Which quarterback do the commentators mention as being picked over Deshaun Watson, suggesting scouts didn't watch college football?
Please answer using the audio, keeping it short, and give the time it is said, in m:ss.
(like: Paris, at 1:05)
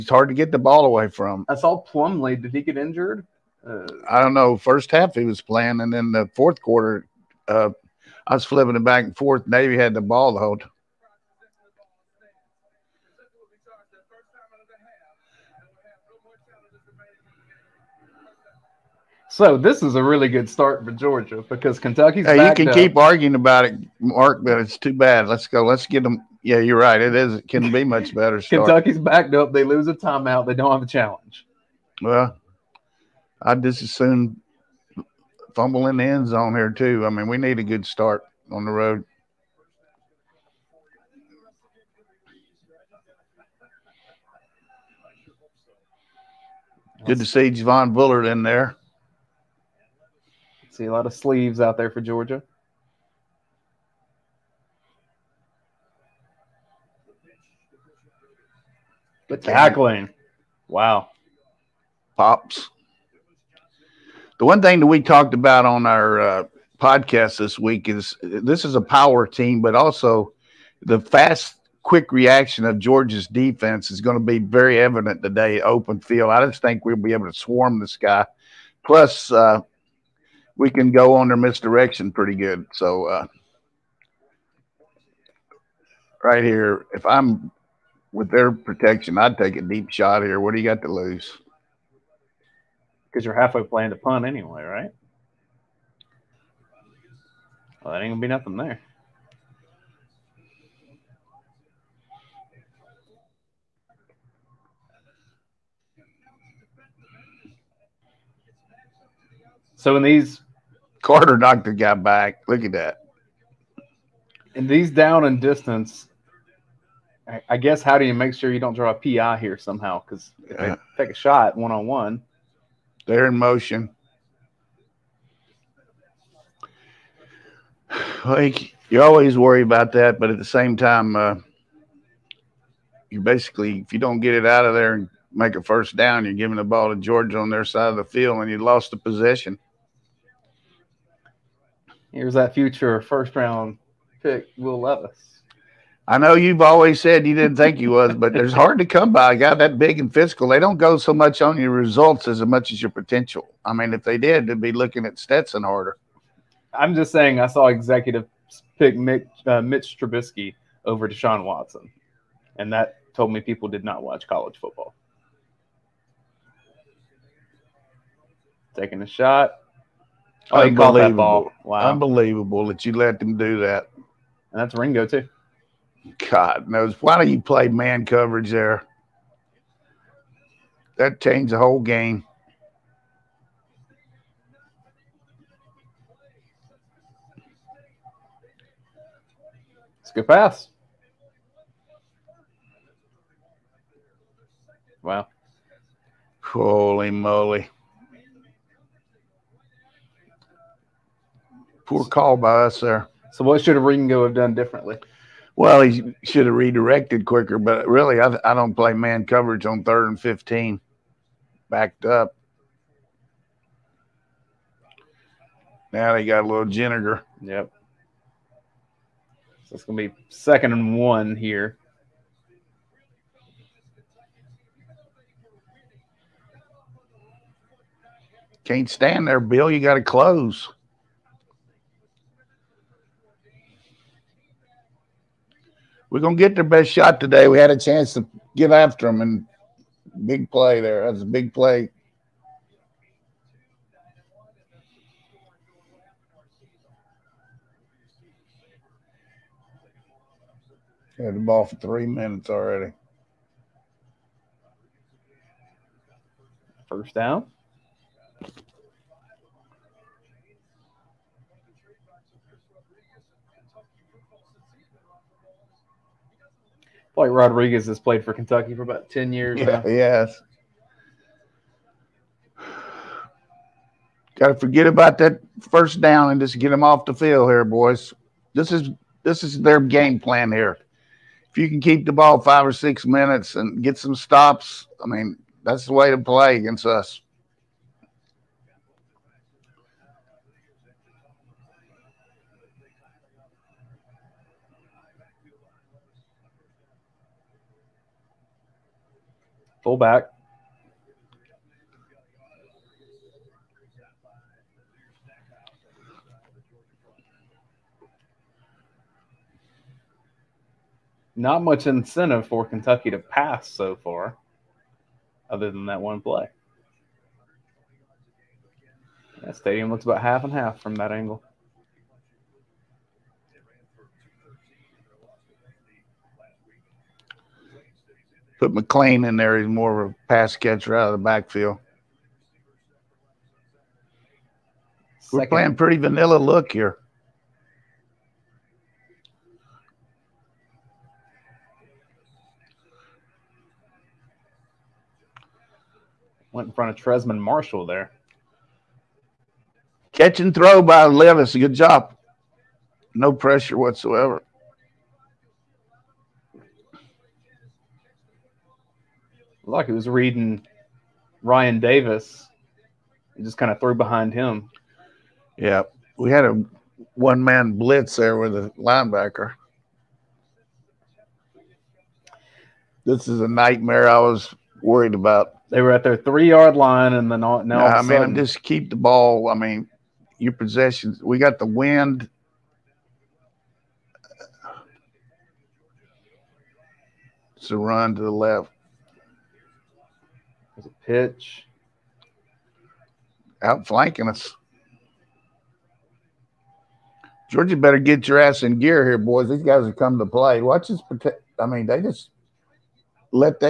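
Mitch Trubisky, at 2:39.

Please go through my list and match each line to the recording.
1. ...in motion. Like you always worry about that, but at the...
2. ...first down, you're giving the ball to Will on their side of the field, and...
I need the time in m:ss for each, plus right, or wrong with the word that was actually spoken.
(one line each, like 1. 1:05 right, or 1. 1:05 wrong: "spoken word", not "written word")
1. 2:03 right
2. 2:15 wrong: "Georgia", not "Will".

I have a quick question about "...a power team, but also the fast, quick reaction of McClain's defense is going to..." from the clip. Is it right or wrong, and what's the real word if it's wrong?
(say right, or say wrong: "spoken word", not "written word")
wrong: "Georgia", not "McClain".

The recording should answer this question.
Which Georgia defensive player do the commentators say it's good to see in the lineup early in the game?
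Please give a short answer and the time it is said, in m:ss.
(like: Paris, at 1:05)
Javon Bullard, at 0:47.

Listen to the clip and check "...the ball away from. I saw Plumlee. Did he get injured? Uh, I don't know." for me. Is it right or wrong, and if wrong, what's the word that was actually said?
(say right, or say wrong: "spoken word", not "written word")
right.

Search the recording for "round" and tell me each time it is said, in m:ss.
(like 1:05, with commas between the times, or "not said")
2:23.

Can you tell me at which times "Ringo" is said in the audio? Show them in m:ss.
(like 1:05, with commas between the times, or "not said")
2:54, 3:23.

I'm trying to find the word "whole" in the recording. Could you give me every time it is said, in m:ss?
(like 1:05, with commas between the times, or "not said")
0:10, 3:01.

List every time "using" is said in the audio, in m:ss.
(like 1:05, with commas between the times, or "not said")
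not said.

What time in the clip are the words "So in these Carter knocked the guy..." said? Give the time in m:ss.
1:49.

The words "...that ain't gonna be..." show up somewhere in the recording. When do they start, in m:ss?
1:37.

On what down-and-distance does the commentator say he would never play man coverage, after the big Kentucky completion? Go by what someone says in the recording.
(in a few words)
third and 15.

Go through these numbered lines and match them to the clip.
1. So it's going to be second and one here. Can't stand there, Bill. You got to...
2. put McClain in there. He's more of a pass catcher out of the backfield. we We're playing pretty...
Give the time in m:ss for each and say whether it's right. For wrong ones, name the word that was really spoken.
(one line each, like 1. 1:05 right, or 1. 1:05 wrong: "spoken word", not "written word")
1. 3:39 right
2. 5:28 right.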